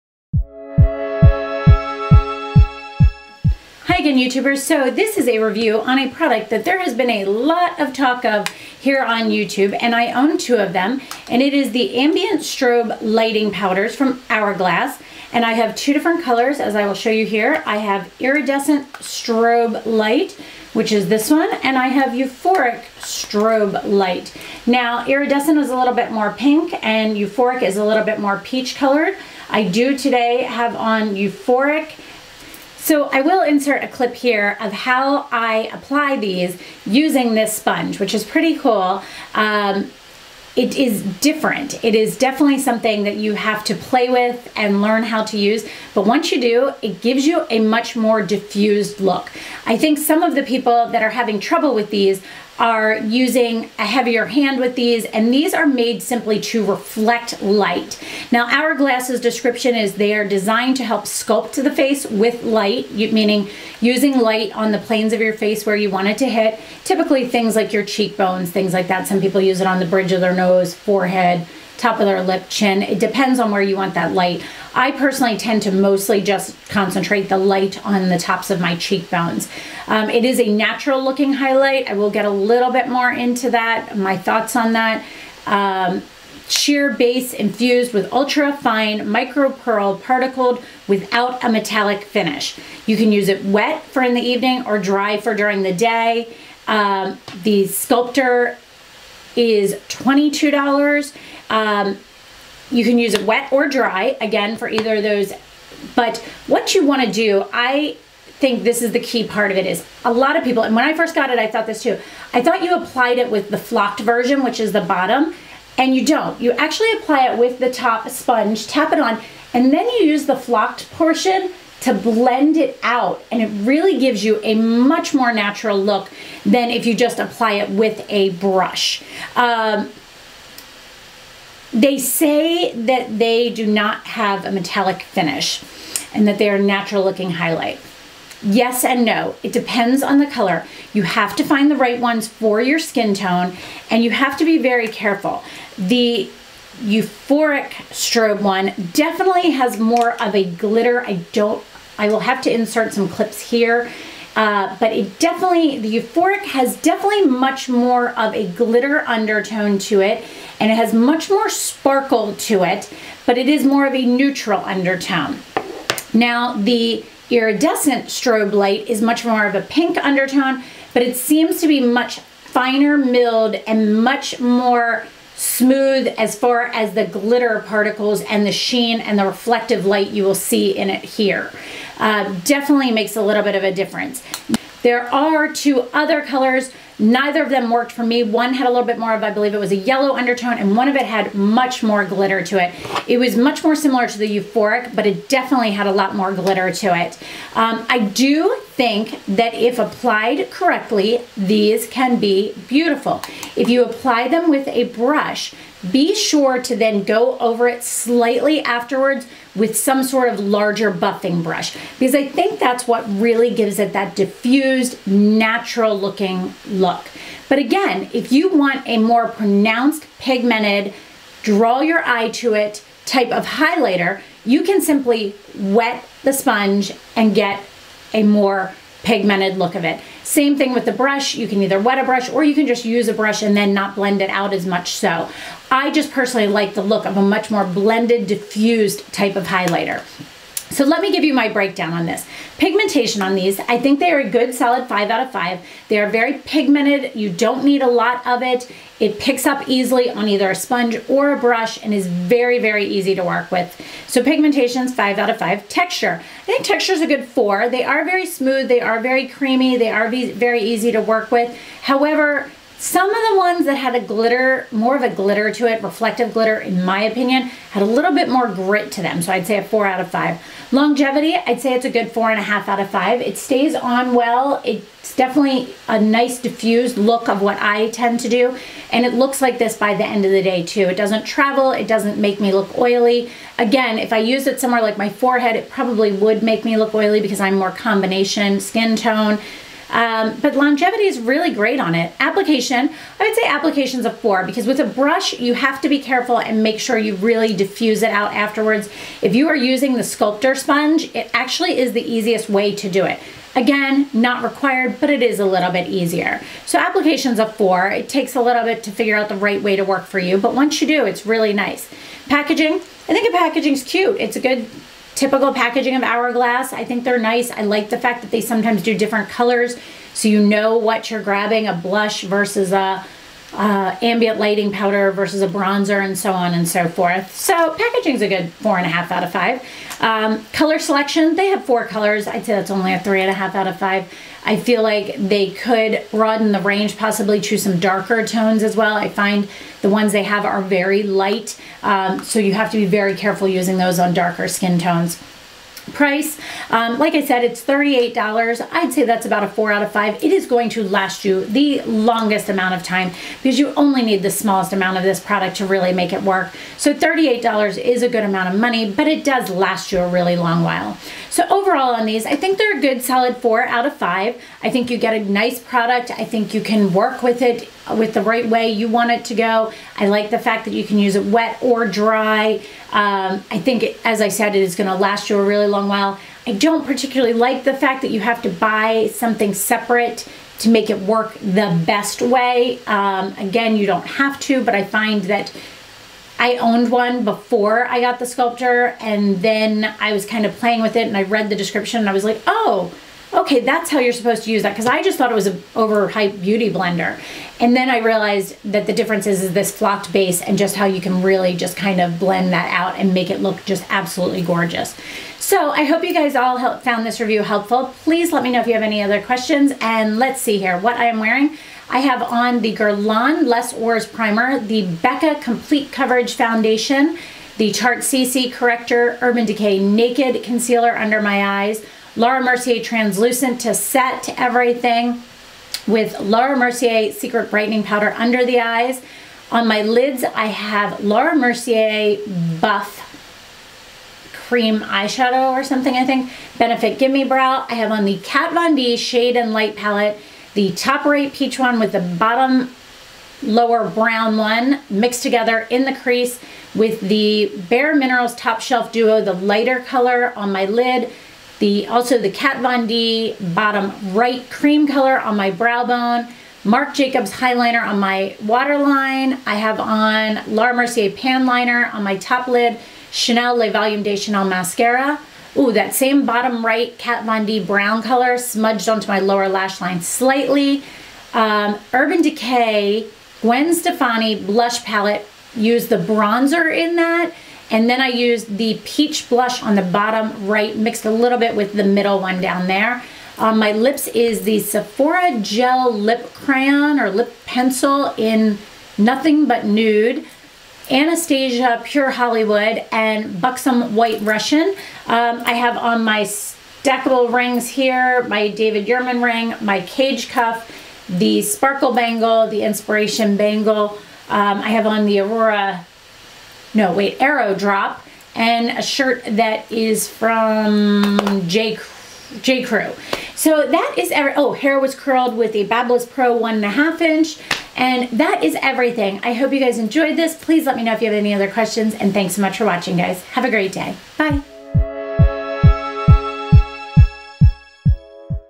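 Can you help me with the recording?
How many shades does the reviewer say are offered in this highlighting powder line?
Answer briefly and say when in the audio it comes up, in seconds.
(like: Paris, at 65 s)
4, at 331 s.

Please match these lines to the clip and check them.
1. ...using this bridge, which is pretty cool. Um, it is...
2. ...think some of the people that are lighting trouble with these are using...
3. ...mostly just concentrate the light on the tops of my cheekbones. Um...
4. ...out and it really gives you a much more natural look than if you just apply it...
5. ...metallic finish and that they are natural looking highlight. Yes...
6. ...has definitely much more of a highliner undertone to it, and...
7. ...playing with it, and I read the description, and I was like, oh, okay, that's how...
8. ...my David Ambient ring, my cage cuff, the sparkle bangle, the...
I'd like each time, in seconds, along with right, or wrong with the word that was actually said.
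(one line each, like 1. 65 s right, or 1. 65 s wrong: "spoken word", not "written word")
1. 36 s wrong: "sponge", not "bridge"
2. 49 s wrong: "having", not "lighting"
3. 75 s right
4. 122 s right
5. 134 s right
6. 156 s wrong: "glitter", not "highliner"
7. 390 s right
8. 498 s wrong: "Yurman", not "Ambient".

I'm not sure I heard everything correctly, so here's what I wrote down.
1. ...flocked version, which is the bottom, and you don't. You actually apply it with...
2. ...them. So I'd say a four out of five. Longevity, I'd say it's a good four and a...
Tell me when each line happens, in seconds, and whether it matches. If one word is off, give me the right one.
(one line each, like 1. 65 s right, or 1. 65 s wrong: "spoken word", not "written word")
1. 113 s right
2. 269 s right.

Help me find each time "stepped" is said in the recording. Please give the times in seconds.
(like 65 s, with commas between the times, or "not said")
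not said.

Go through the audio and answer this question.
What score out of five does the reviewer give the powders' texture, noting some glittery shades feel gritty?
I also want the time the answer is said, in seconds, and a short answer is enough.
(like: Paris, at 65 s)
4, at 255 s.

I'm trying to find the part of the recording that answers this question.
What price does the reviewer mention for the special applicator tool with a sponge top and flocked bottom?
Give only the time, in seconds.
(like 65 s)
99 s.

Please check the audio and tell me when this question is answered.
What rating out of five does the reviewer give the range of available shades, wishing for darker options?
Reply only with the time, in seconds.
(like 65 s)
332 s.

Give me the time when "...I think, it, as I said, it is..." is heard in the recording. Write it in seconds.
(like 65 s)
373 s.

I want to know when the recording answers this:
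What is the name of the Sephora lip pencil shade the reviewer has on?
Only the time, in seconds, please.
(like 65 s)
488 s.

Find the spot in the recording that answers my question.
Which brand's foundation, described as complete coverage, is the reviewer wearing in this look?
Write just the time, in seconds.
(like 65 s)
414 s.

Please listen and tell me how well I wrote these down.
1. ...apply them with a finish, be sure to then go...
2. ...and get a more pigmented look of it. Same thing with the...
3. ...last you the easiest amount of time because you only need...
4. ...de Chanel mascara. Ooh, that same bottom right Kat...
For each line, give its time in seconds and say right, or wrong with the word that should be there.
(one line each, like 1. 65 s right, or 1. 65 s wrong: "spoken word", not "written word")
1. 203 s wrong: "brush", not "finish"
2. 227 s right
3. 350 s wrong: "longest", not "easiest"
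4. 464 s right.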